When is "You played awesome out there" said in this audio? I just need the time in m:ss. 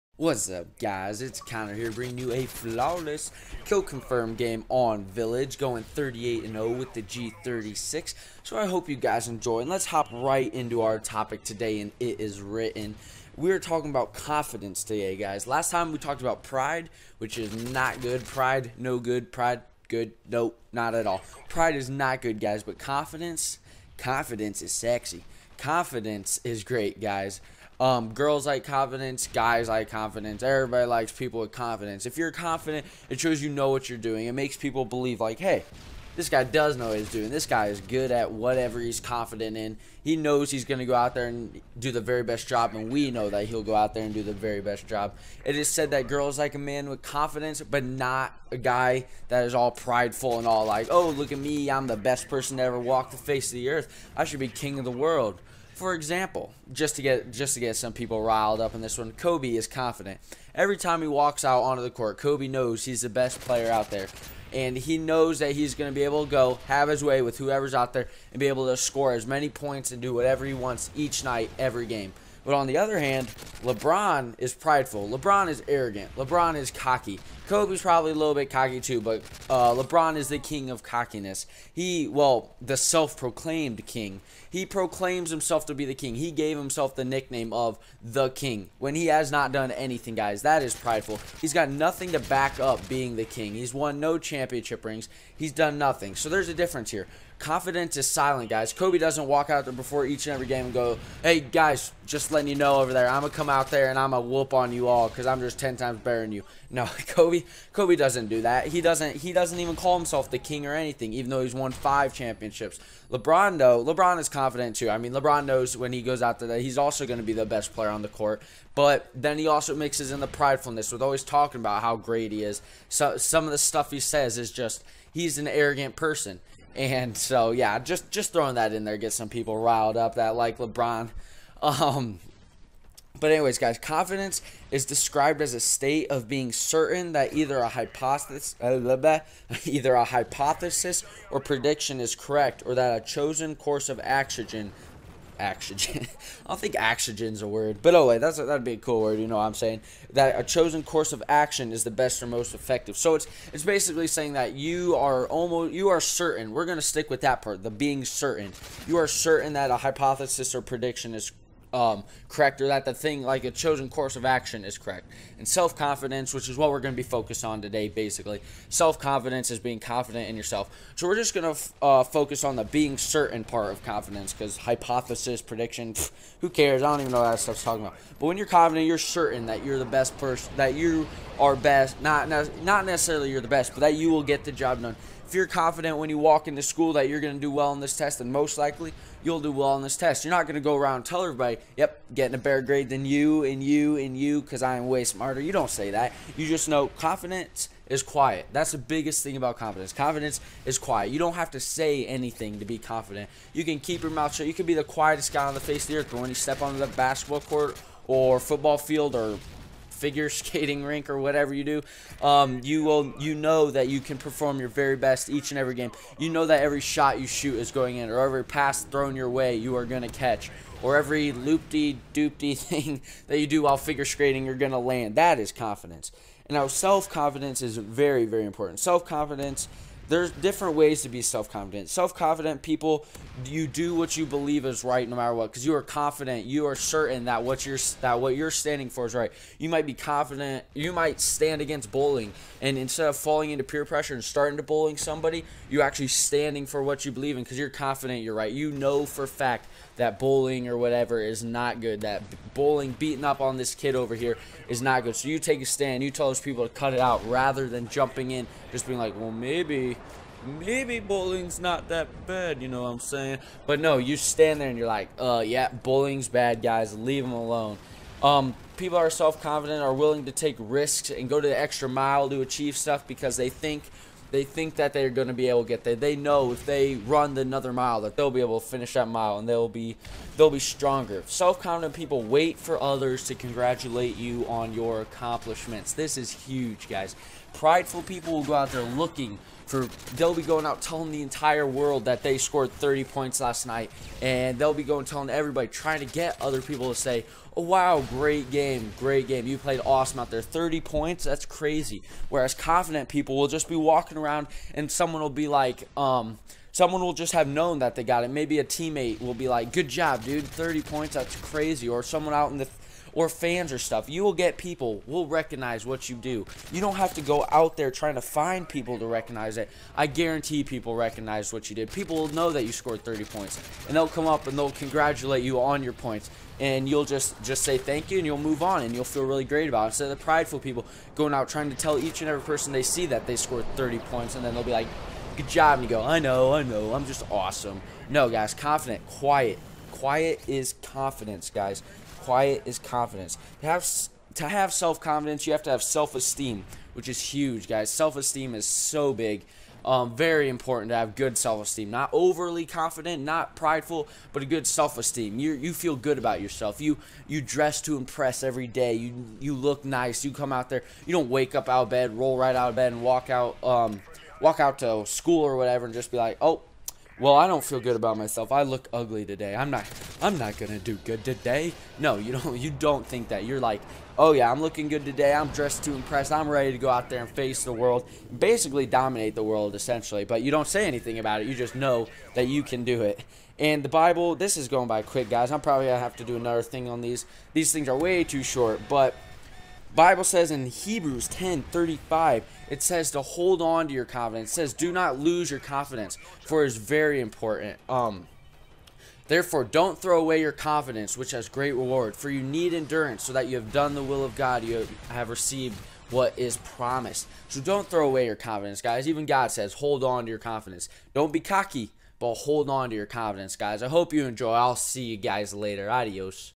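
4:59.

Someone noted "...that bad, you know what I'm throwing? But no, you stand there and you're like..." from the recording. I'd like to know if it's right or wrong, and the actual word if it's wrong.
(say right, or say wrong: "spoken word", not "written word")
wrong: "saying", not "throwing".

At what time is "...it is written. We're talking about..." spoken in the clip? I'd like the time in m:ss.
0:11.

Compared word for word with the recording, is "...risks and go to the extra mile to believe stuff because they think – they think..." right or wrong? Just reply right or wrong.
wrong.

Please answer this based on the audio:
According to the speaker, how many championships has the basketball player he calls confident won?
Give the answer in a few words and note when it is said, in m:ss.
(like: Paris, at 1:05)
5, at 1:51.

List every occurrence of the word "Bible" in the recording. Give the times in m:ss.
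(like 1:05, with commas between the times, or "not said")
6:23, 6:29.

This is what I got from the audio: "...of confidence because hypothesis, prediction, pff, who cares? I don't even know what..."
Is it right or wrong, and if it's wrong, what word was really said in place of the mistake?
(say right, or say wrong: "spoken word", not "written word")
right.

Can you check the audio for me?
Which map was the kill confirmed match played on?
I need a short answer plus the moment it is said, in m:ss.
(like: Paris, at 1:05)
Village, at 0:05.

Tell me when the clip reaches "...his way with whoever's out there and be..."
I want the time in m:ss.
1:06.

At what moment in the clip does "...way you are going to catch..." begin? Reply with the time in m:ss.
3:39.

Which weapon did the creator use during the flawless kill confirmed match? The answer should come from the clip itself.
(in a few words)
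G36.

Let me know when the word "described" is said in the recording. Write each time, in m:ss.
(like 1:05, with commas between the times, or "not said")
2:14.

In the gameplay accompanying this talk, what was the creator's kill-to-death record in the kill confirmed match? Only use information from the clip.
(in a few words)
38-0.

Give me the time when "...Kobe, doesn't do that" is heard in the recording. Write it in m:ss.
1:47.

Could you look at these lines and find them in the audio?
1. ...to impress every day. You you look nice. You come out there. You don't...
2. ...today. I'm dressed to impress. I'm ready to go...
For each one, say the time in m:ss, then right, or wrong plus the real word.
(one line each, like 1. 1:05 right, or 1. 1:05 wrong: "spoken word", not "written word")
1. 5:57 right
2. 6:15 right.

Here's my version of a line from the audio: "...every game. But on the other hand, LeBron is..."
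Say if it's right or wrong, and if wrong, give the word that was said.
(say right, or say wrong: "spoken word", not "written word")
right.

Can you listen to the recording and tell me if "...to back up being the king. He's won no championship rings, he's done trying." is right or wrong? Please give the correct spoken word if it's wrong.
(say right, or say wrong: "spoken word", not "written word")
wrong: "nothing", not "trying".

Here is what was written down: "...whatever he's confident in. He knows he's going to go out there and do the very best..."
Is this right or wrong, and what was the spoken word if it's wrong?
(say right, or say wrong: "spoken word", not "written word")
right.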